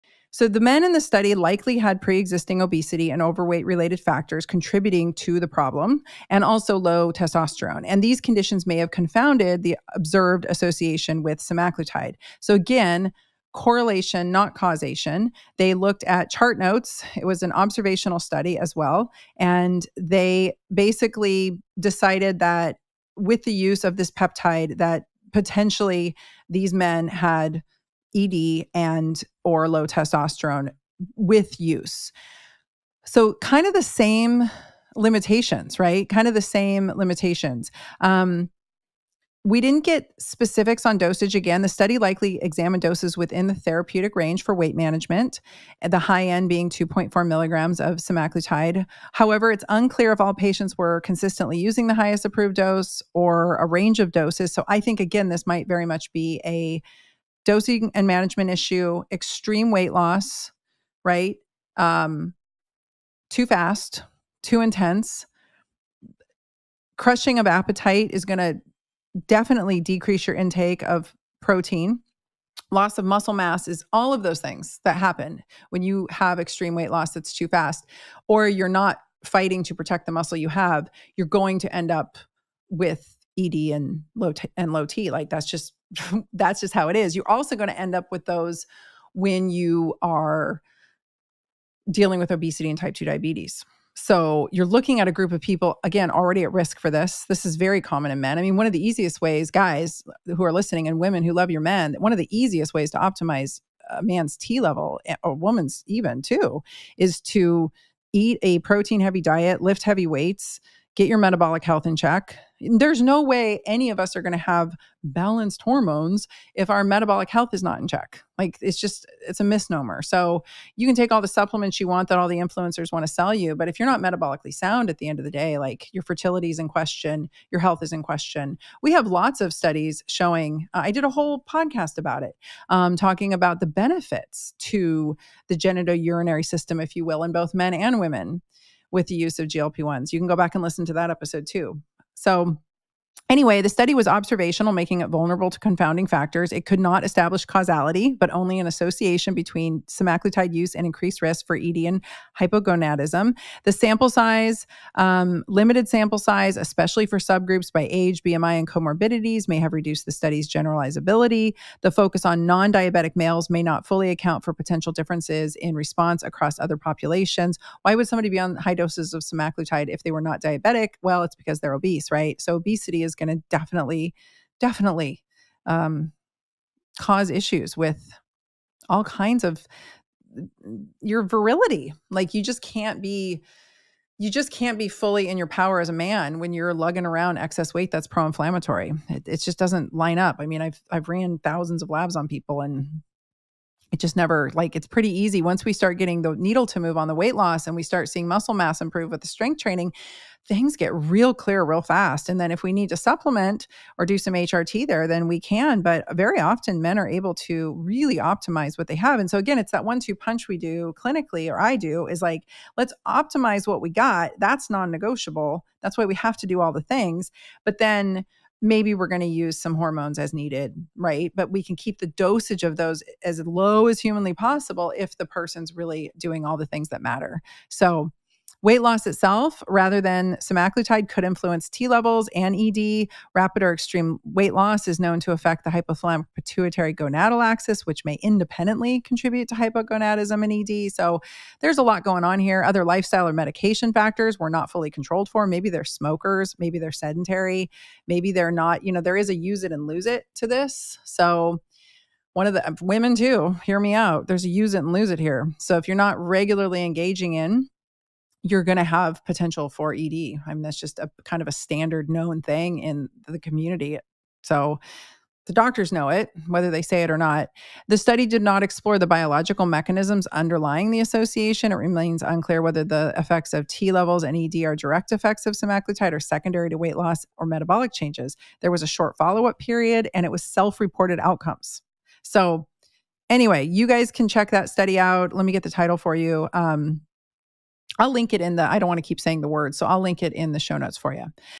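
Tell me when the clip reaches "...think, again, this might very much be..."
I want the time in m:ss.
0:54.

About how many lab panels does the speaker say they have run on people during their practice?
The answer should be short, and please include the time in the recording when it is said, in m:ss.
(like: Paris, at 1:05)
thousands, at 3:11.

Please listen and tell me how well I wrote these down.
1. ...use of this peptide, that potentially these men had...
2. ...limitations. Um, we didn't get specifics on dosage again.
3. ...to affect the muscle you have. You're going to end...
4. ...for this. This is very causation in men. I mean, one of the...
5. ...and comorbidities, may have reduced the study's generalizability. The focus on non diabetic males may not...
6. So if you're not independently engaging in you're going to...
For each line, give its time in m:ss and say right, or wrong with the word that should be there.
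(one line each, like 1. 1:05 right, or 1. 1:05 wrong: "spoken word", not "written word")
1. 0:23 right
2. 0:36 right
3. 1:19 wrong: "protect", not "affect"
4. 1:36 wrong: "common", not "causation"
5. 2:38 right
6. 4:15 wrong: "regularly", not "independently".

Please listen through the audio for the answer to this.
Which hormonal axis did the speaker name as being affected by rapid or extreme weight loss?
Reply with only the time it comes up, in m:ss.
3:55.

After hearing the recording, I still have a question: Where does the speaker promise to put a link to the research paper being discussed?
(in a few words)
show notes.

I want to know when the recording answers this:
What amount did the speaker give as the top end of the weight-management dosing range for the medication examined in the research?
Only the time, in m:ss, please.
0:46.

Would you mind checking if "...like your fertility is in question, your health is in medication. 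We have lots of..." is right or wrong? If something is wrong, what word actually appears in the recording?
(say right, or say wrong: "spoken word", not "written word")
wrong: "question", not "medication".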